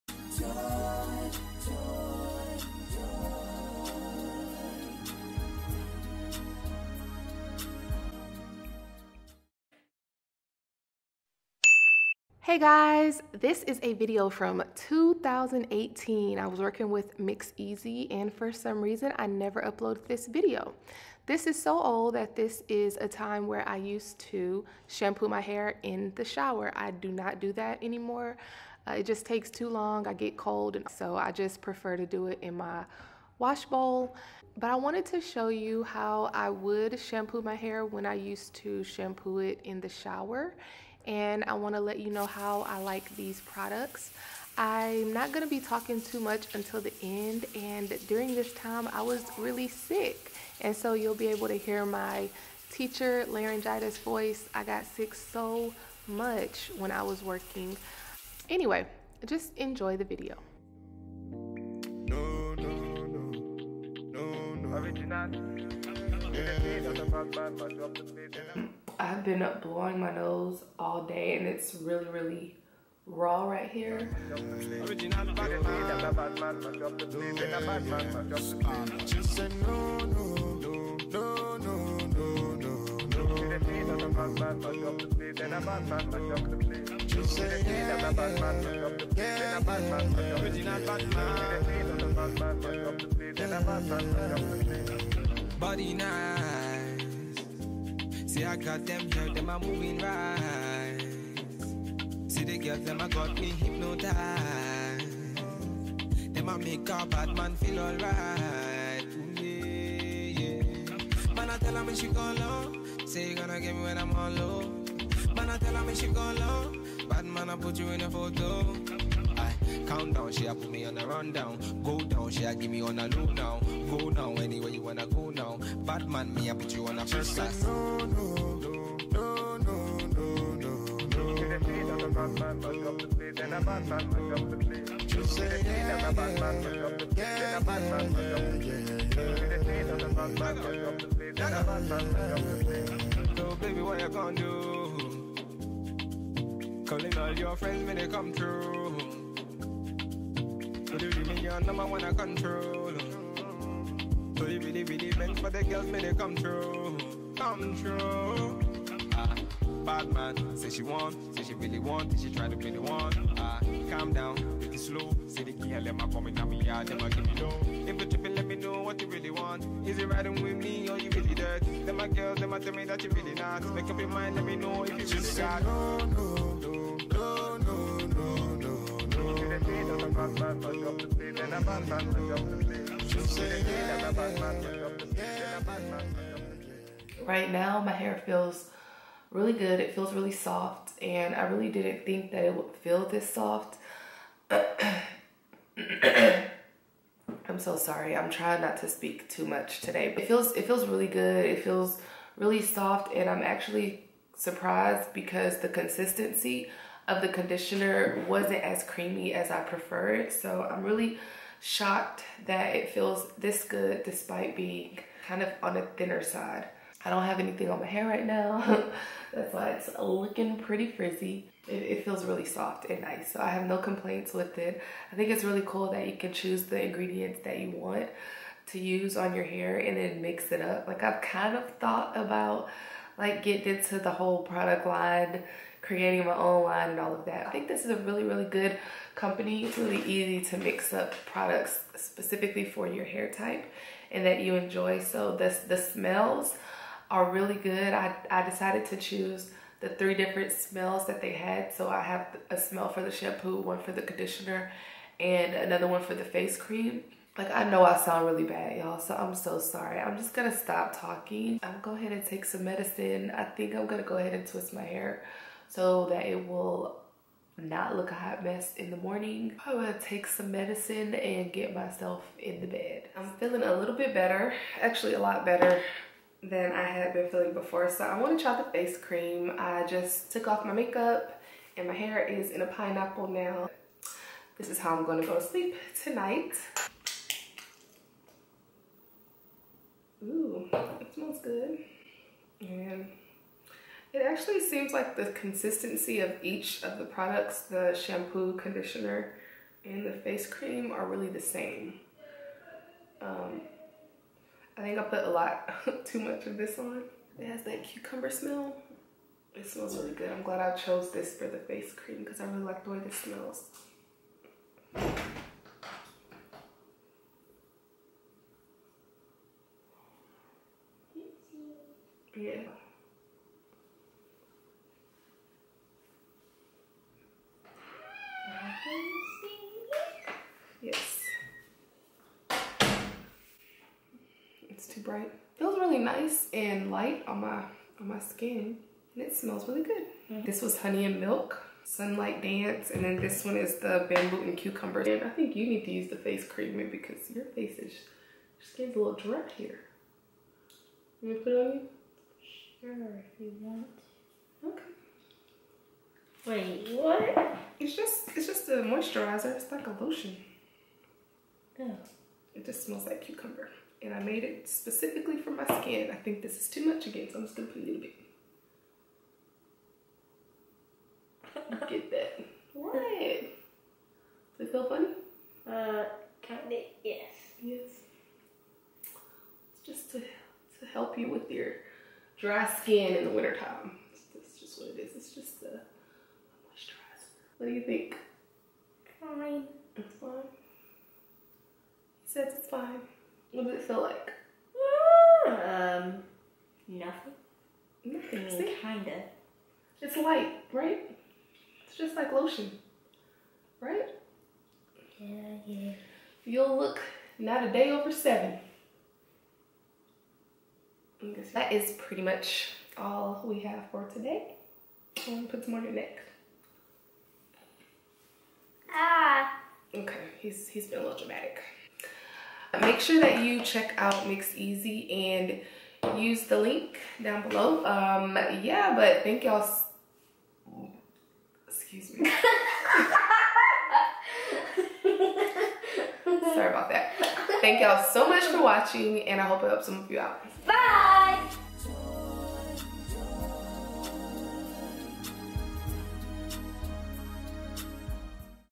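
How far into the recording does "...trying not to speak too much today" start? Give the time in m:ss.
3:18.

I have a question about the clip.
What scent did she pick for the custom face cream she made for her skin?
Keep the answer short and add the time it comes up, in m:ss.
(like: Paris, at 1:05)
Bamboo and cucumber, at 5:44.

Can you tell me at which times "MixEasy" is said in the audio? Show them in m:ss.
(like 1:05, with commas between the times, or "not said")
0:17, 7:04.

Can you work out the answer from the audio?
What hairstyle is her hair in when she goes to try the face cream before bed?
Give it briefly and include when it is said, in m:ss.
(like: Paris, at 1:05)
A pineapple, at 4:42.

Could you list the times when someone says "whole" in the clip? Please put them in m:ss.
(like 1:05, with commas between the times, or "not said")
3:54.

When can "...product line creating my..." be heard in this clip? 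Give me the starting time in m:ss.
3:54.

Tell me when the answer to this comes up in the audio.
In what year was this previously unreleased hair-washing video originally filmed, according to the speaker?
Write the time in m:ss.
0:14.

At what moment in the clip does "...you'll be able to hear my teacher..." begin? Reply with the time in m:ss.
0:50.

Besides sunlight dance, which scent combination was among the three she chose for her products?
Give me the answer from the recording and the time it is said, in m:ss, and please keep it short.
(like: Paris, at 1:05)
Honey and milk, at 5:40.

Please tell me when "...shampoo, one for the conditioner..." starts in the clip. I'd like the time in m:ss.
4:13.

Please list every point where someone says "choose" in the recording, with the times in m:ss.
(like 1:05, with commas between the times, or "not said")
3:46, 4:08.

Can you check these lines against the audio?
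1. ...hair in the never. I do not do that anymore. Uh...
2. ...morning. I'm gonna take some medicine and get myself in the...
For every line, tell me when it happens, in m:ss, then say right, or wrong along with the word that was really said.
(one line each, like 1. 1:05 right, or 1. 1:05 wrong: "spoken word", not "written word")
1. 0:25 wrong: "shower", not "never"
2. 4:28 right.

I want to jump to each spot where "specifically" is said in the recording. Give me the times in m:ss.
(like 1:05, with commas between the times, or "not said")
4:01, 6:04.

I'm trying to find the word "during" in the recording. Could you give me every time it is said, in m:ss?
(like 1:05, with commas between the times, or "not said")
0:48.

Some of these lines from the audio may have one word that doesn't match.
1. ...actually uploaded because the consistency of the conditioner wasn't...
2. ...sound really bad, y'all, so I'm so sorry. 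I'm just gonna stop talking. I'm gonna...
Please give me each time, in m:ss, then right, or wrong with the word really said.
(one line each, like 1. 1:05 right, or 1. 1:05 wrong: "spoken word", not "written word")
1. 3:23 wrong: "surprised", not "uploaded"
2. 4:17 right.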